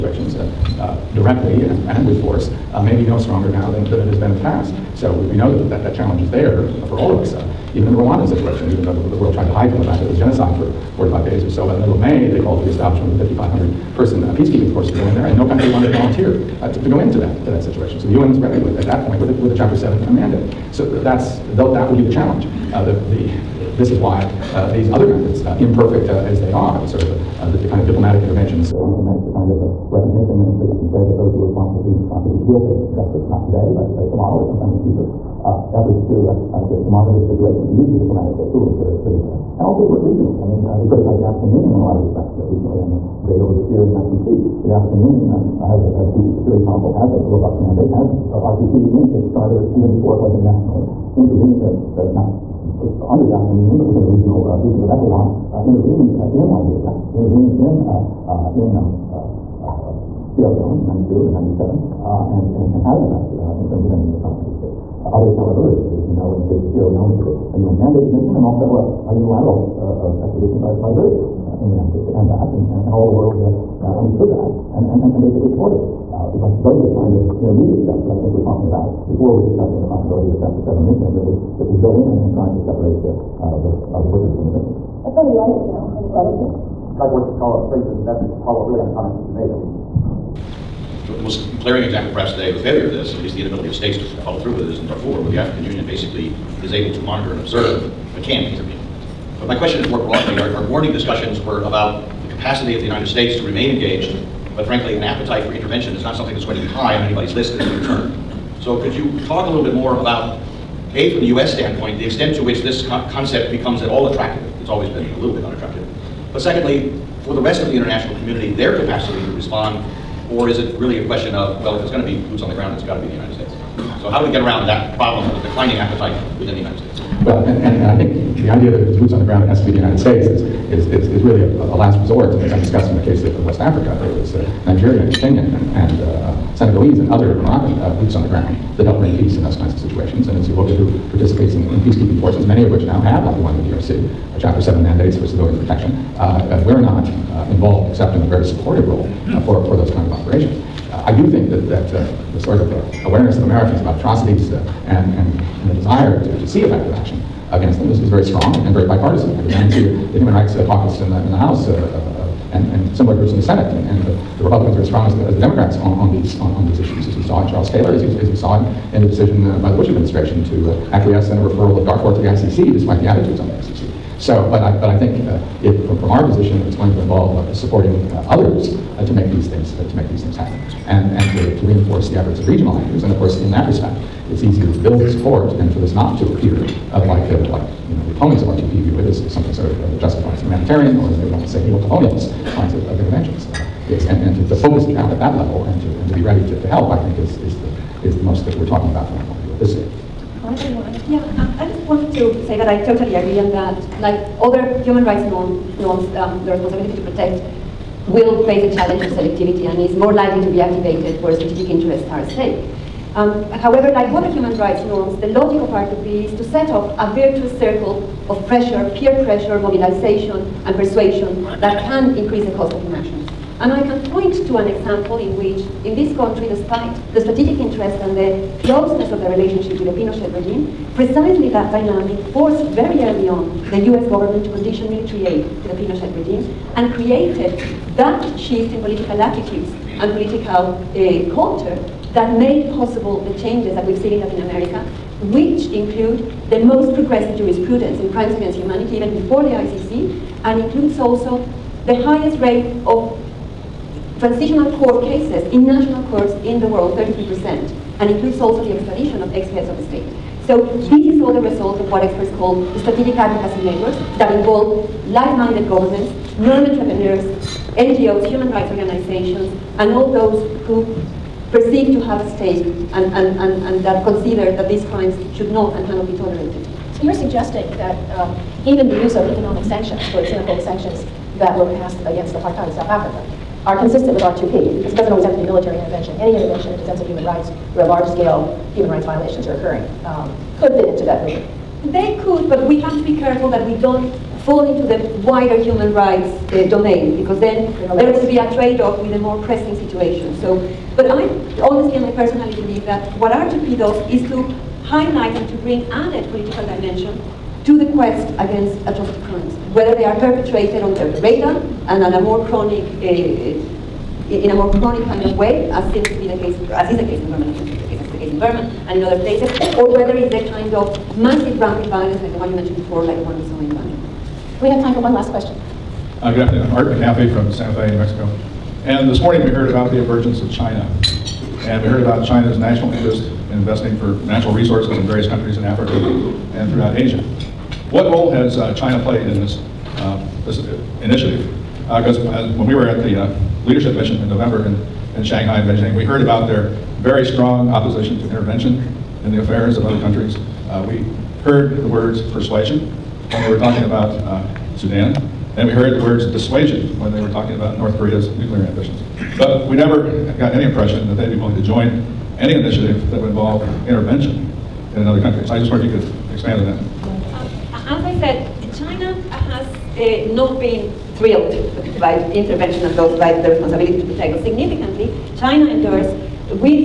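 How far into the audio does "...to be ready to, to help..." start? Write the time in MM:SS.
03:16.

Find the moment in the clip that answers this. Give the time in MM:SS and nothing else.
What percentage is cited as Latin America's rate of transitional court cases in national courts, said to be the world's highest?
04:16.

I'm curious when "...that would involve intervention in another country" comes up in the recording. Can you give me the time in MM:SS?
06:03.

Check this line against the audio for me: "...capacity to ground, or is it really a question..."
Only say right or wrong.
wrong.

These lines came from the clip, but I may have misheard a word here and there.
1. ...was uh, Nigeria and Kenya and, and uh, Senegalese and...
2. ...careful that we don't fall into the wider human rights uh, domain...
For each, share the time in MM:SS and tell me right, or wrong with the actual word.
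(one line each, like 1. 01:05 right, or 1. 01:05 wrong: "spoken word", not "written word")
1. 02:14 right
2. 04:53 right.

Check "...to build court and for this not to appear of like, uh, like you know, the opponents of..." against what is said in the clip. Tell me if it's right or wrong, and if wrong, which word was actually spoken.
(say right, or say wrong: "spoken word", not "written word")
wrong: "support", not "court".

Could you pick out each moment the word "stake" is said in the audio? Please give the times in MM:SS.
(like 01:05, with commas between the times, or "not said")
03:32, 04:32.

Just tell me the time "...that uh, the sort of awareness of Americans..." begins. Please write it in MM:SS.
02:31.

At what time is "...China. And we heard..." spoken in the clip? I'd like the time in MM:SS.
05:30.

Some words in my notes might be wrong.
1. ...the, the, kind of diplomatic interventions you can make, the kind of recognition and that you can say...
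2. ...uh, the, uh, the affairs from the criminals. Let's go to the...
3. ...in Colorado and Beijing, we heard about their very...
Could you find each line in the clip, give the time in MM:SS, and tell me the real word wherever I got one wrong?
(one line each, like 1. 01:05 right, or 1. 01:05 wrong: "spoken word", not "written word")
1. 00:27 right
2. 01:23 wrong: "butchers", not "affairs"
3. 05:45 wrong: "Shanghai", not "Colorado".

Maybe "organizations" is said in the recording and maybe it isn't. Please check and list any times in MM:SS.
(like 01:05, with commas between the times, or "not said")
04:28.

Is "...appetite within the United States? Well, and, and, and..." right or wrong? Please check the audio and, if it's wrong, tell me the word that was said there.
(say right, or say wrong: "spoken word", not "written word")
right.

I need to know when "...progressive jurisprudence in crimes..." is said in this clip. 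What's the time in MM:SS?
04:06.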